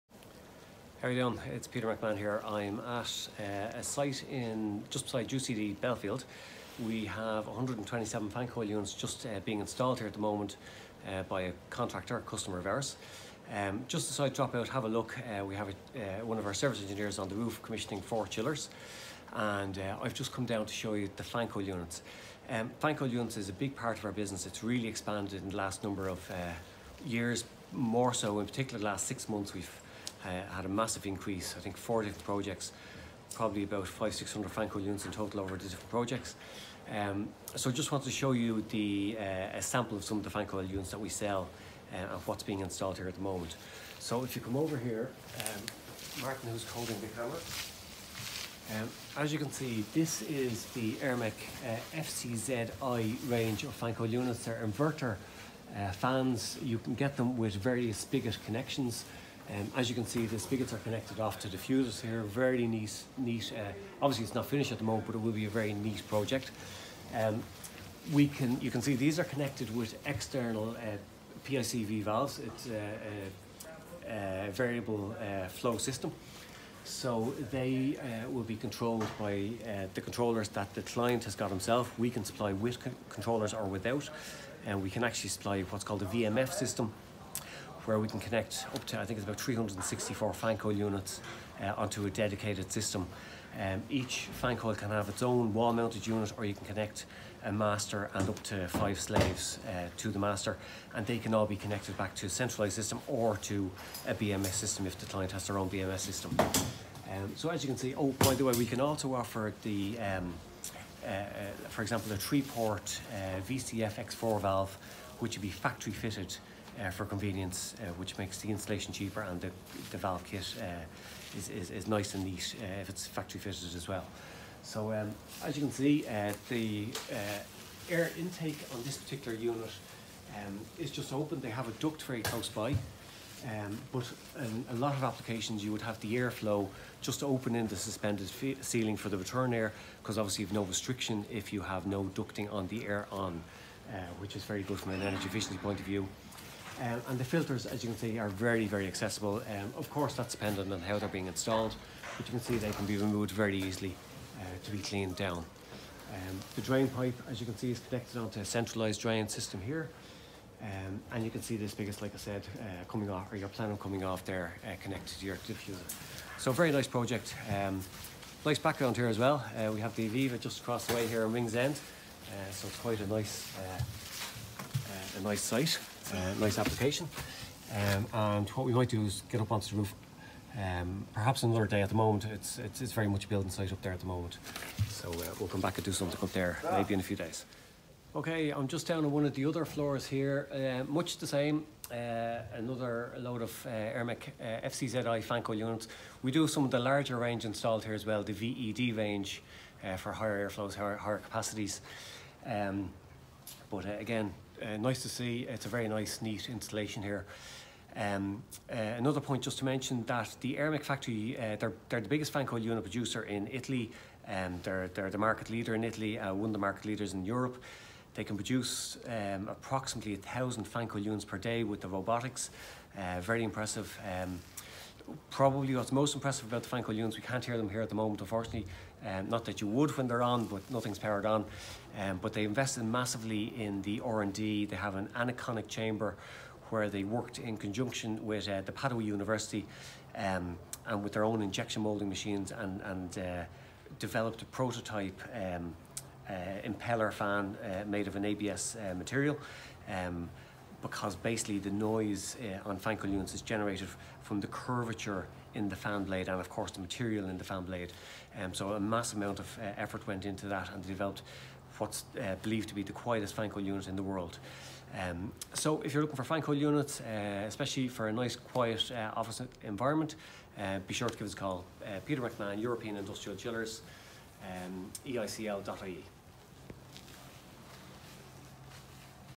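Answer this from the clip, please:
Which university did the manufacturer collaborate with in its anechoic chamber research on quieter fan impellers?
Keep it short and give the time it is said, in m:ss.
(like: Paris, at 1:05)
Padua University, at 3:58.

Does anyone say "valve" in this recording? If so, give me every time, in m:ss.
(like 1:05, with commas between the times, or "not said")
1:12, 1:54, 1:59.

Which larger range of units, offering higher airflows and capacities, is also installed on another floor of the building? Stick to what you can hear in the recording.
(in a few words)
VED.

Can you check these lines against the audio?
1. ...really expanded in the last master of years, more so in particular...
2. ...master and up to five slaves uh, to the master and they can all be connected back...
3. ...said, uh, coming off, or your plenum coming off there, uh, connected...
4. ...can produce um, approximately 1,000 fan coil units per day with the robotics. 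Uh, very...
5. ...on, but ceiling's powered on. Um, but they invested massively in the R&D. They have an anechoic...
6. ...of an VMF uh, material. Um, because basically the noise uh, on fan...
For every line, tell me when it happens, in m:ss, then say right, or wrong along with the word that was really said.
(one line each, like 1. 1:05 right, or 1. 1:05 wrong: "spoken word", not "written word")
1. 0:24 wrong: "number", not "master"
2. 1:37 right
3. 2:42 right
4. 3:38 right
5. 3:50 wrong: "nothing", not "ceiling"
6. 4:08 wrong: "ABS", not "VMF".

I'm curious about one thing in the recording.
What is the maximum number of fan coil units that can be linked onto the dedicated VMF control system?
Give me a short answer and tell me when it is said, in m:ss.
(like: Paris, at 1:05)
364, at 1:29.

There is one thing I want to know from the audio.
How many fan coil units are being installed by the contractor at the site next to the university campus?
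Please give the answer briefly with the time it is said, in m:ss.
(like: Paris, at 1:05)
127, at 0:07.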